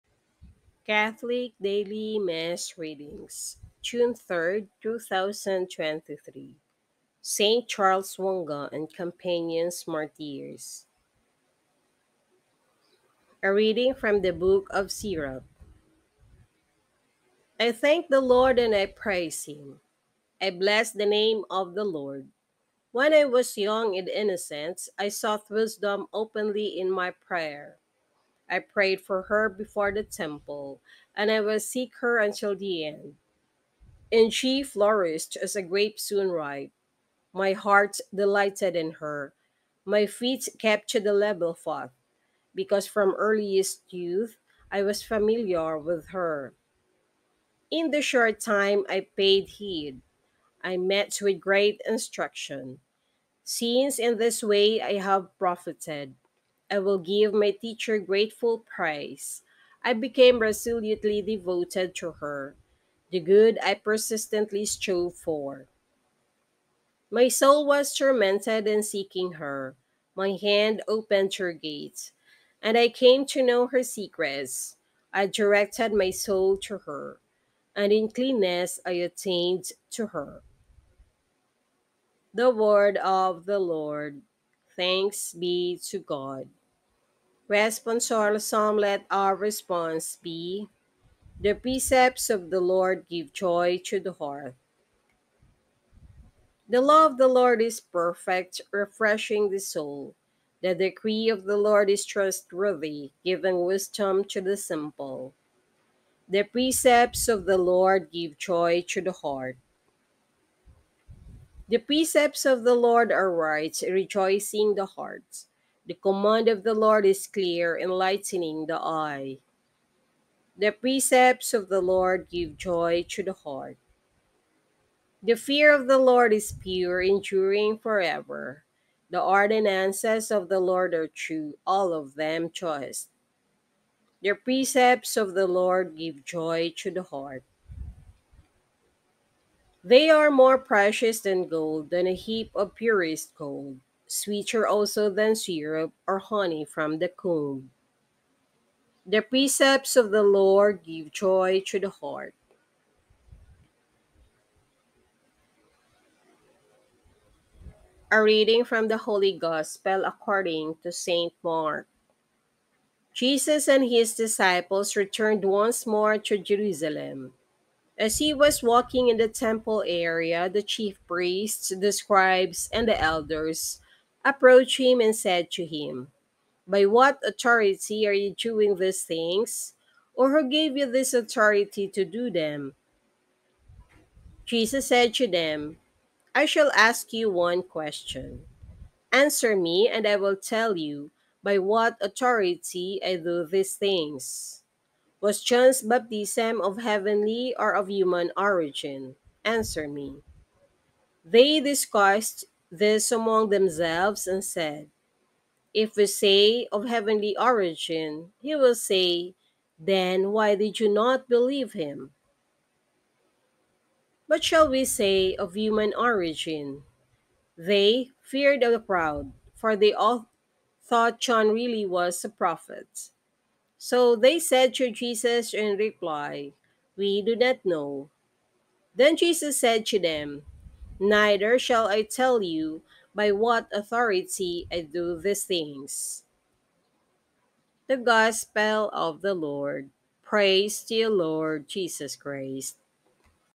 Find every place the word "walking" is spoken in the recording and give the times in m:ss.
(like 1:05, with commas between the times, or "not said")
2:48.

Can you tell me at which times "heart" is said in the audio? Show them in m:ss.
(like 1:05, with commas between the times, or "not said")
0:37, 1:34, 1:49, 1:54, 2:03, 2:17, 2:31.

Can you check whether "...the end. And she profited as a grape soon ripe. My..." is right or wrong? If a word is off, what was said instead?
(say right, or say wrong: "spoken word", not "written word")
wrong: "flourished", not "profited".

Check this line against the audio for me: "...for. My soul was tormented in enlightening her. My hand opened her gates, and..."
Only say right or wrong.
wrong.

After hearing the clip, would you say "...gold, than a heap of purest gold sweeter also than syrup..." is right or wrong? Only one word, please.
right.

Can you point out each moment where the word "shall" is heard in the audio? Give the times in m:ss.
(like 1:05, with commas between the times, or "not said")
3:06, 3:34, 3:51.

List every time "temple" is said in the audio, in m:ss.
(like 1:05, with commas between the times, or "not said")
0:30, 2:49.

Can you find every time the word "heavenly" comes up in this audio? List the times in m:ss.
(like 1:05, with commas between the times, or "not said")
3:16, 3:26.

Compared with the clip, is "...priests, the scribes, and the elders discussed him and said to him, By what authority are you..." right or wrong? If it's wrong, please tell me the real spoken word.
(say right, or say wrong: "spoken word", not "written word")
wrong: "approached", not "discussed".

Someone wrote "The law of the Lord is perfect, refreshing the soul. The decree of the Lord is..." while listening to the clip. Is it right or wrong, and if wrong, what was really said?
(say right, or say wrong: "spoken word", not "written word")
right.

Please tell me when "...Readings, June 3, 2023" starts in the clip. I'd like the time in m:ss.
0:02.